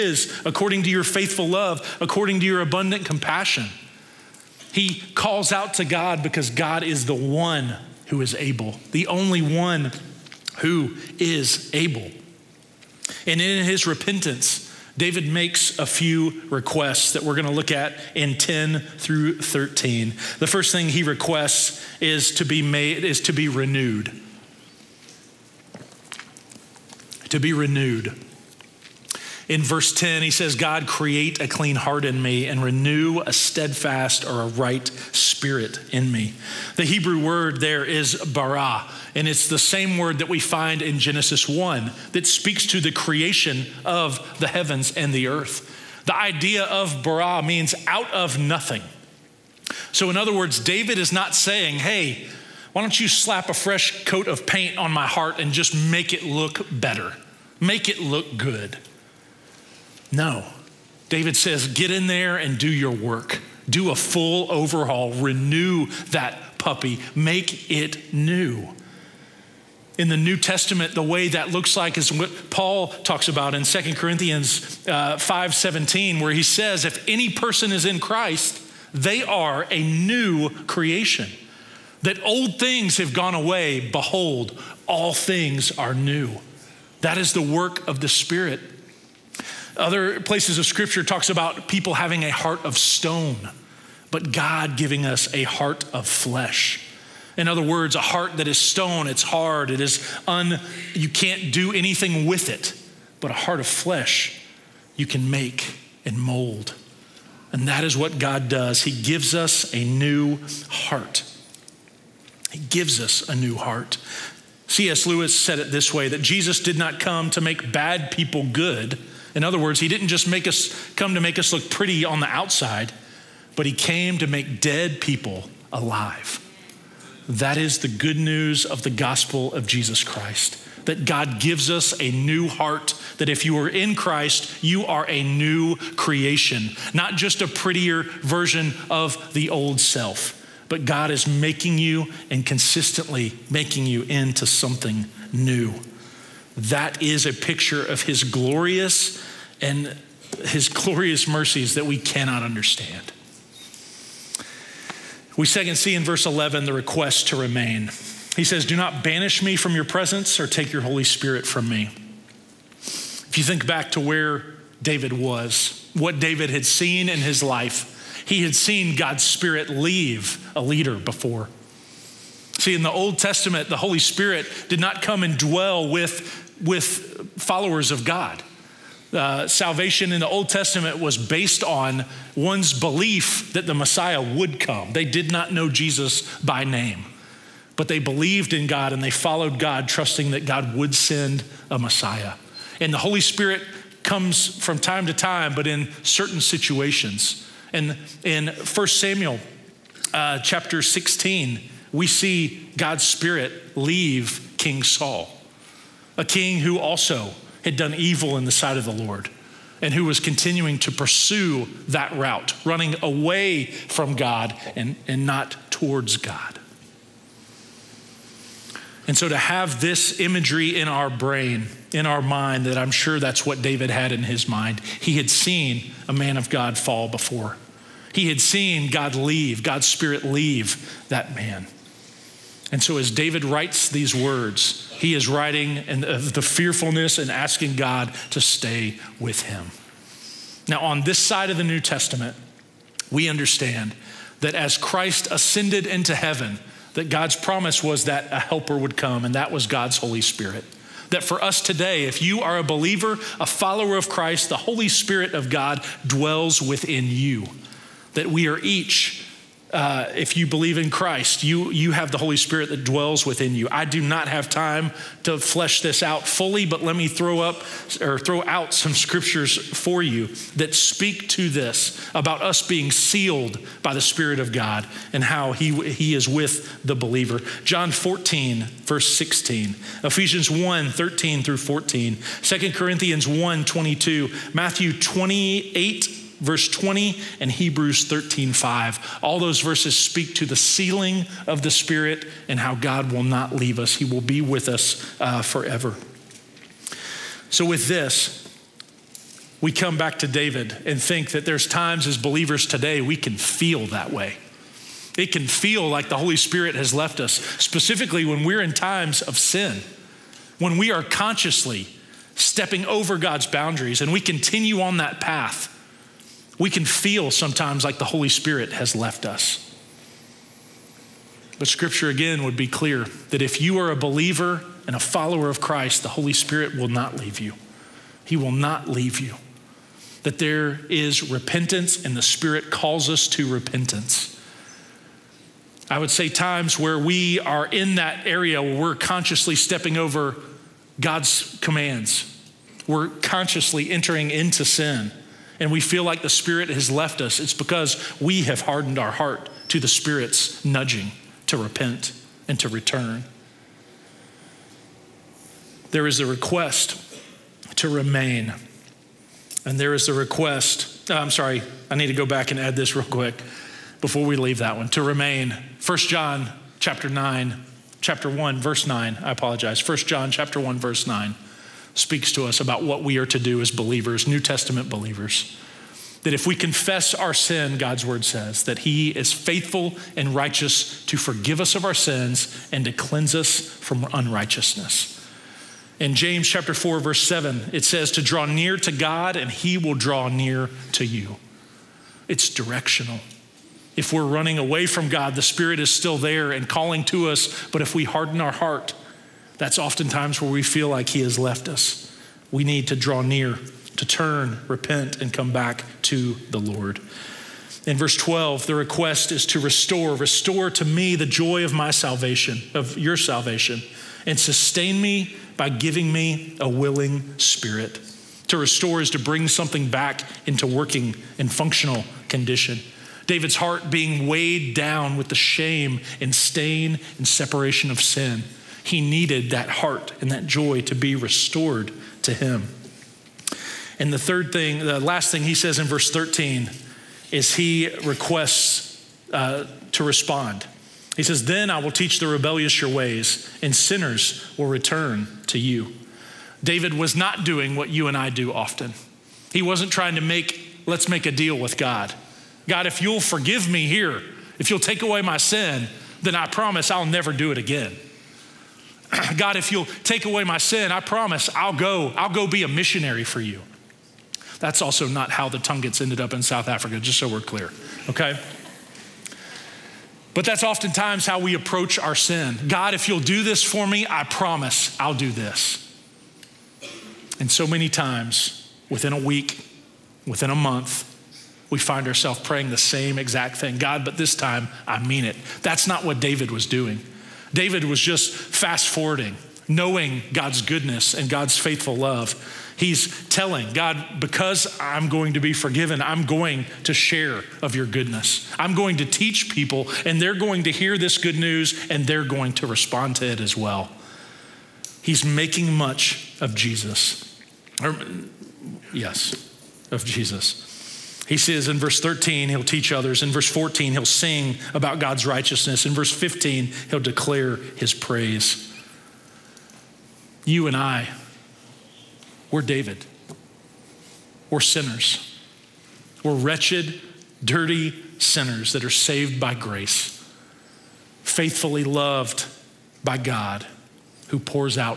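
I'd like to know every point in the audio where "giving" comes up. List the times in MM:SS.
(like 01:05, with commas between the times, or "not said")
01:34, 06:55.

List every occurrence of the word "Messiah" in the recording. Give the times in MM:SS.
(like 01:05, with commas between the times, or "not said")
03:03, 03:11.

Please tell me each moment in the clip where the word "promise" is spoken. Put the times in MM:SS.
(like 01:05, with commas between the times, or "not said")
04:07, 07:36, 07:40, 07:54.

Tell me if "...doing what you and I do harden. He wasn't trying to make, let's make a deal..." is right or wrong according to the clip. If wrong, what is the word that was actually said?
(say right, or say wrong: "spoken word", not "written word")
wrong: "often", not "harden".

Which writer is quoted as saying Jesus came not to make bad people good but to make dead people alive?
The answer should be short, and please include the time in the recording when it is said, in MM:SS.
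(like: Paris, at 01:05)
C.S. Lewis, at 01:54.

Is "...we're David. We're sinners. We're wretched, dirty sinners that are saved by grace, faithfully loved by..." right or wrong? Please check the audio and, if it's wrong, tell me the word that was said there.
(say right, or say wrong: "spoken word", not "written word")
right.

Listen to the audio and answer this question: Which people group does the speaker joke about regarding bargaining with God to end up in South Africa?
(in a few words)
Tungans.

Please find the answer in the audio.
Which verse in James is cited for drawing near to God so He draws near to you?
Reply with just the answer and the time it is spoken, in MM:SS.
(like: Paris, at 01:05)
James 4:7, at 06:26.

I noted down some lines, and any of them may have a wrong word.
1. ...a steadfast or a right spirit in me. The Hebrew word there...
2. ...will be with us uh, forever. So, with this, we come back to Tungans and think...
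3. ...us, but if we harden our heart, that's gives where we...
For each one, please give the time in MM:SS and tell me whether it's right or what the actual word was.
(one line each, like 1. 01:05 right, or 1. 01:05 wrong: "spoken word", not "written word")
1. 00:33 right
2. 04:54 wrong: "David", not "Tungans"
3. 06:37 wrong: "oftentimes", not "gives".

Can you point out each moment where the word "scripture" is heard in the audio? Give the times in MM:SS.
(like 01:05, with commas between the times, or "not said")
01:30, 04:28, 05:21.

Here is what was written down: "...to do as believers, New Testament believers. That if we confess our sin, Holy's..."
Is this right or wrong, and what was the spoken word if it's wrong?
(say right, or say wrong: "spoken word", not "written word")
wrong: "God", not "Holy".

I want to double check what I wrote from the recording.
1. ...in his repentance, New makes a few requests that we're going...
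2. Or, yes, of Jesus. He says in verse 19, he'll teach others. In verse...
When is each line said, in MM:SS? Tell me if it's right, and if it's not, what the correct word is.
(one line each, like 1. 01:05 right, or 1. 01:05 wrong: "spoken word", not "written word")
1. 00:13 wrong: "David", not "New"
2. 08:27 wrong: "13", not "19".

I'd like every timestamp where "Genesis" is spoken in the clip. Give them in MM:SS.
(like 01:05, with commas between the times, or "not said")
00:40.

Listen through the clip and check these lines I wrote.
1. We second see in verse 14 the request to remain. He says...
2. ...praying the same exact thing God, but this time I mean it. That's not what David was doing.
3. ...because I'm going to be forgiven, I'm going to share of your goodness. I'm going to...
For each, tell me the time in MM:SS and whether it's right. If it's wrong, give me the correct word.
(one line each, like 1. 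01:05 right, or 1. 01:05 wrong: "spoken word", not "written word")
1. 02:35 wrong: "11", not "14"
2. 08:02 right
3. 08:14 right.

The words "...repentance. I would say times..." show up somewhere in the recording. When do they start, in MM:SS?
05:33.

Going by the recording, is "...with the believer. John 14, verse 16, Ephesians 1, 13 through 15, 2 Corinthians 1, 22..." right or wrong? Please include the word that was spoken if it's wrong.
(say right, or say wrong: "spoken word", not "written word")
wrong: "14", not "15".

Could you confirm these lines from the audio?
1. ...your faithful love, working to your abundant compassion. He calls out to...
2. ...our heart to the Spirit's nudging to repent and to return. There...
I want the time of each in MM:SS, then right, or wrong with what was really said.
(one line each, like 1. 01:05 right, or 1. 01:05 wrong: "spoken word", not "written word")
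1. 00:00 wrong: "according", not "working"
2. 05:48 right.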